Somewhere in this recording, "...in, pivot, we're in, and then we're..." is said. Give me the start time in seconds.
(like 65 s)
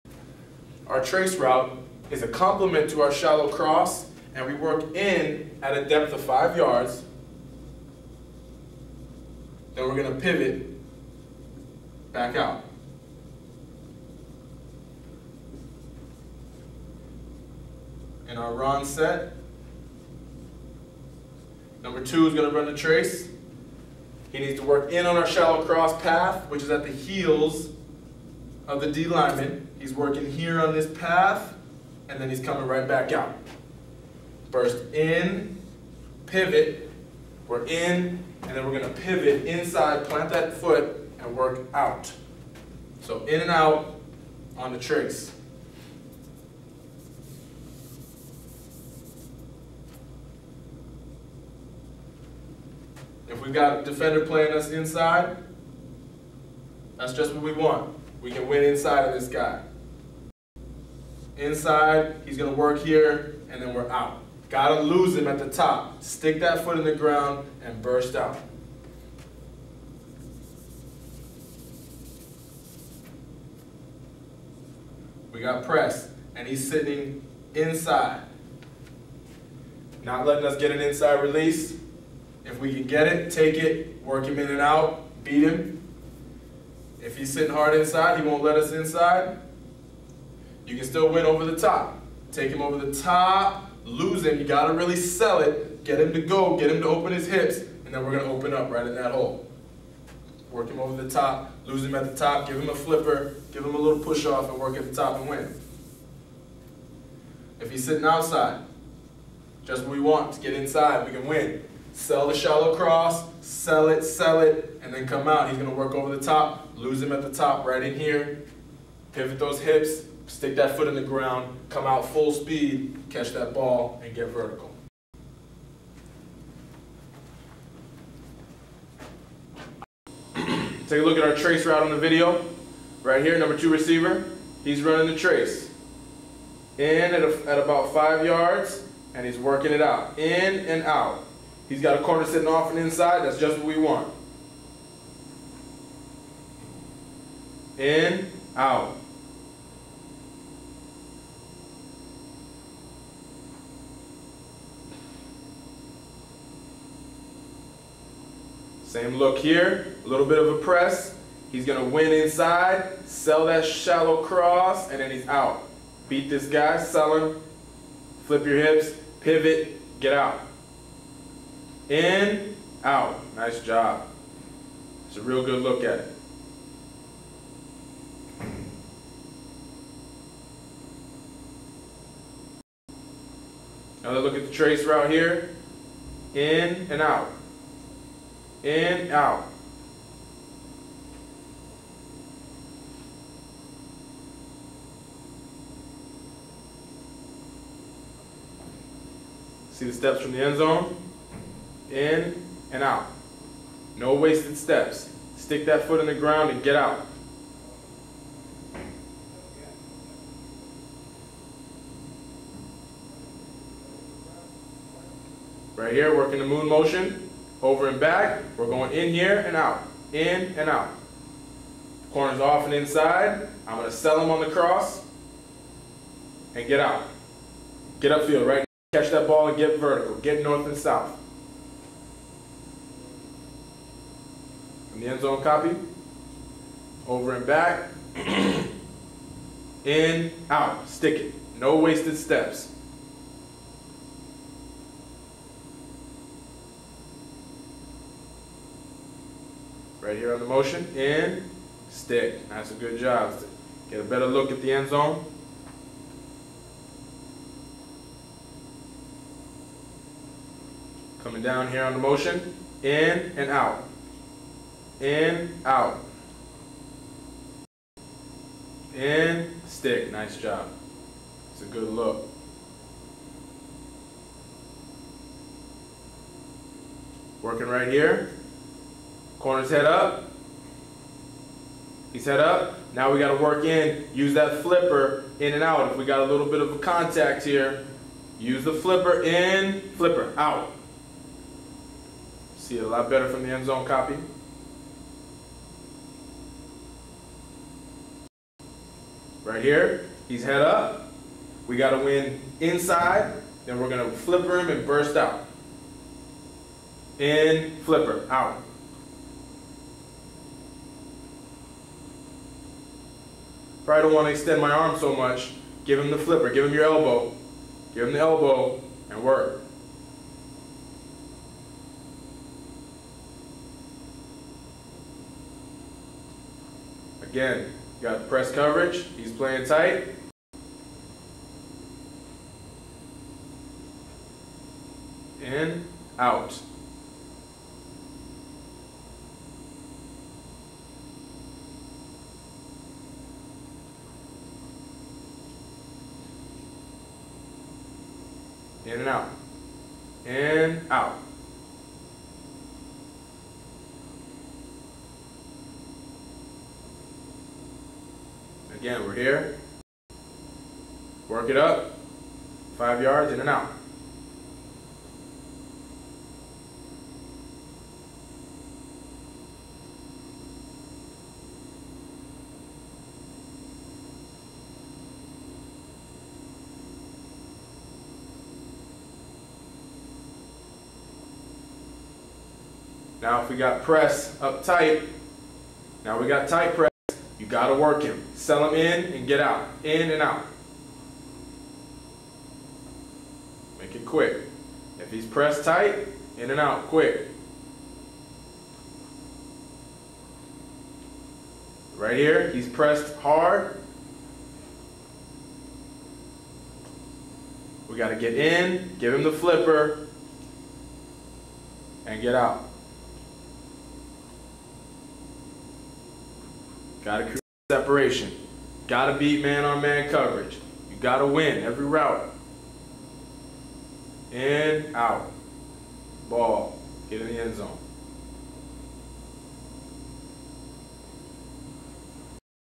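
34 s.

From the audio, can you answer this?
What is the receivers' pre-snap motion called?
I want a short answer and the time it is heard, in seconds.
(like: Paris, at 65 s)
Moon motion, at 216 s.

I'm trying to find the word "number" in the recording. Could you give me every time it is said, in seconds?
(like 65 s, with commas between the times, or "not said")
21 s, 133 s.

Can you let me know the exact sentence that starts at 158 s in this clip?
Same look here, a little bit of a press.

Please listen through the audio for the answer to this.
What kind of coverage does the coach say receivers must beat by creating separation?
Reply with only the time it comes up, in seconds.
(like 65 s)
419 s.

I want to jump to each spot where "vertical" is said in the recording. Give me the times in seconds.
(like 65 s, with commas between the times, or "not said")
124 s, 229 s.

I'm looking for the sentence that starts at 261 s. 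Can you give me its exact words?
Coming down here on the motion.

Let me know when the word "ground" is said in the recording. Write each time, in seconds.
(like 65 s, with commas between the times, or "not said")
66 s, 121 s, 206 s.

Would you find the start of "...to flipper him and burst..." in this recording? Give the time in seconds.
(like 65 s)
304 s.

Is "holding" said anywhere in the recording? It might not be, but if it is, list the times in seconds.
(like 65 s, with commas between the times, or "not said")
not said.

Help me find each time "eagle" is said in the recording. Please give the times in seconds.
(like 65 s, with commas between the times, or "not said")
not said.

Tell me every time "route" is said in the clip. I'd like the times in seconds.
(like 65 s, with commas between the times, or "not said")
1 s, 131 s, 184 s, 421 s.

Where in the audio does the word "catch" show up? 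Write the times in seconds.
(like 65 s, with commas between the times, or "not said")
123 s, 228 s.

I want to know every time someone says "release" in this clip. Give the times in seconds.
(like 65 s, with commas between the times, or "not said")
81 s.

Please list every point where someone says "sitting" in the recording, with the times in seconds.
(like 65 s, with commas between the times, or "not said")
76 s, 87 s, 107 s, 142 s.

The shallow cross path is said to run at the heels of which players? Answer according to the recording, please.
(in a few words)
D lineman.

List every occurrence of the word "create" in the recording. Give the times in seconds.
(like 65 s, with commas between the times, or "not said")
417 s.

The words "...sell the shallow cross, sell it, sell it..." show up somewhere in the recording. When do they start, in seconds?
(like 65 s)
111 s.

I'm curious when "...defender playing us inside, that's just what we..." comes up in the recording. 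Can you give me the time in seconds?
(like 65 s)
53 s.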